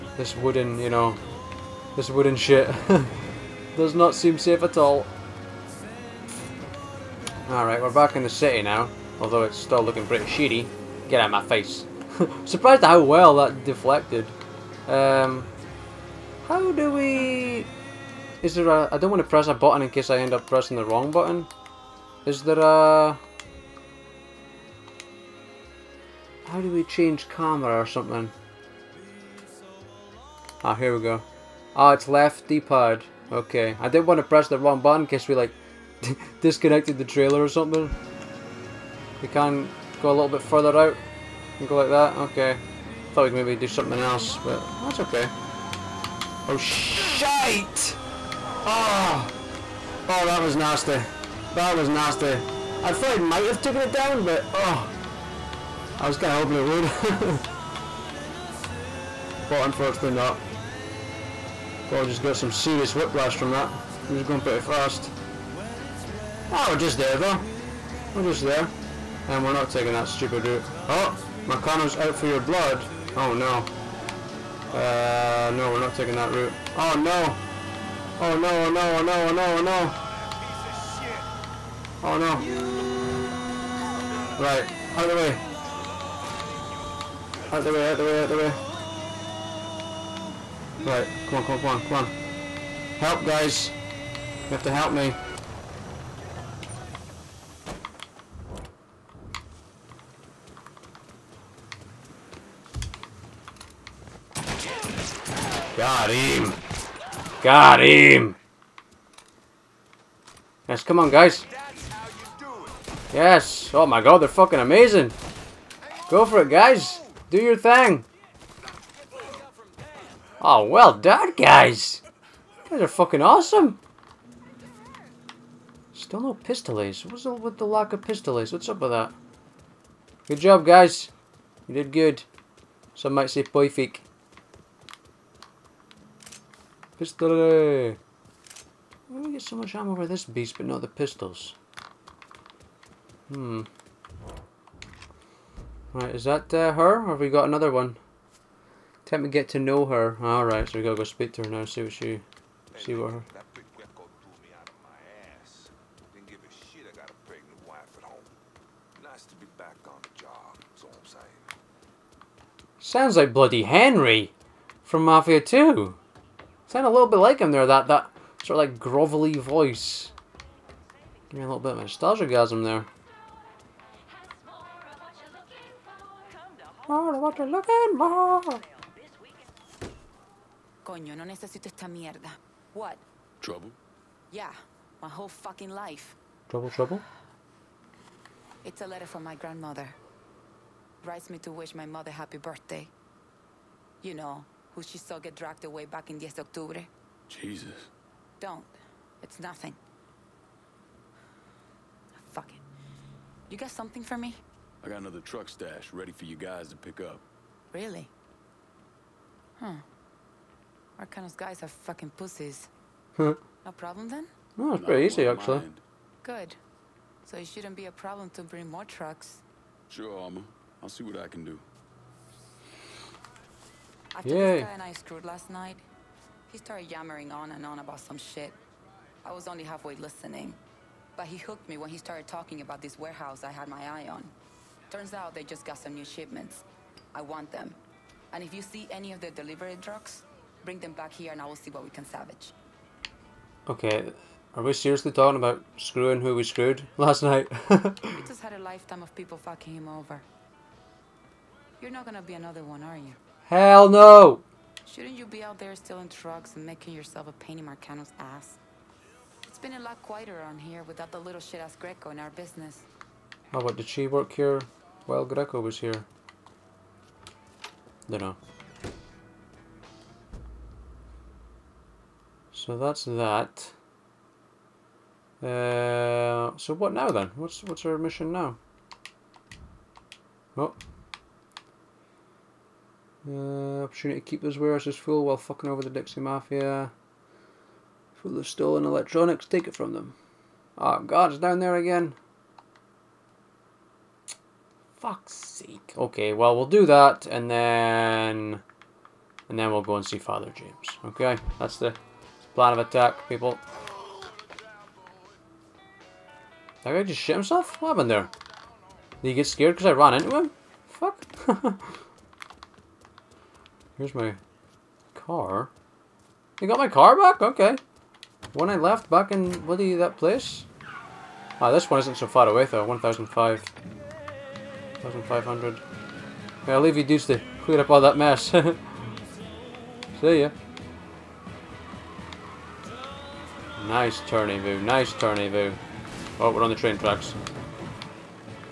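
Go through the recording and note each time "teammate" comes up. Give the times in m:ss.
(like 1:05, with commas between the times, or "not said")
not said.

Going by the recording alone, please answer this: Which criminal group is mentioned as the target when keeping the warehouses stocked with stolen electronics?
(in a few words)
Dixie Mafia.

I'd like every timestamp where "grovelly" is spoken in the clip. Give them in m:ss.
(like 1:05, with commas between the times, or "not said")
2:48.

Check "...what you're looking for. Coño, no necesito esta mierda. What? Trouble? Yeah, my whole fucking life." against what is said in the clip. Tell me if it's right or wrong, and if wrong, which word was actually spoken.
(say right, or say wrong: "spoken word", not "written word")
right.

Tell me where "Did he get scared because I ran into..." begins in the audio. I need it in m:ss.
5:09.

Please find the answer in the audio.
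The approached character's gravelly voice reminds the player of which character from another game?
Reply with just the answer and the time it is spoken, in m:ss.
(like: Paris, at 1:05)
Henry, at 2:43.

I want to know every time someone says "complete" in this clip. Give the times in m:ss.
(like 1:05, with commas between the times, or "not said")
not said.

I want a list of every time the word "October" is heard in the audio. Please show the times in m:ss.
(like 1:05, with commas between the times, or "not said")
3:16.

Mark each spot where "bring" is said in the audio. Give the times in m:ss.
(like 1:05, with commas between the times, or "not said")
3:38, 4:00.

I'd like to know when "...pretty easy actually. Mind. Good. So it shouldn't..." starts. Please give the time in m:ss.
3:34.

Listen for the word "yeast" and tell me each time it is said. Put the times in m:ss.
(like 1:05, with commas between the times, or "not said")
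not said.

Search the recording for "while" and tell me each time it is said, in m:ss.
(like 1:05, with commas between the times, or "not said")
4:25, 4:45.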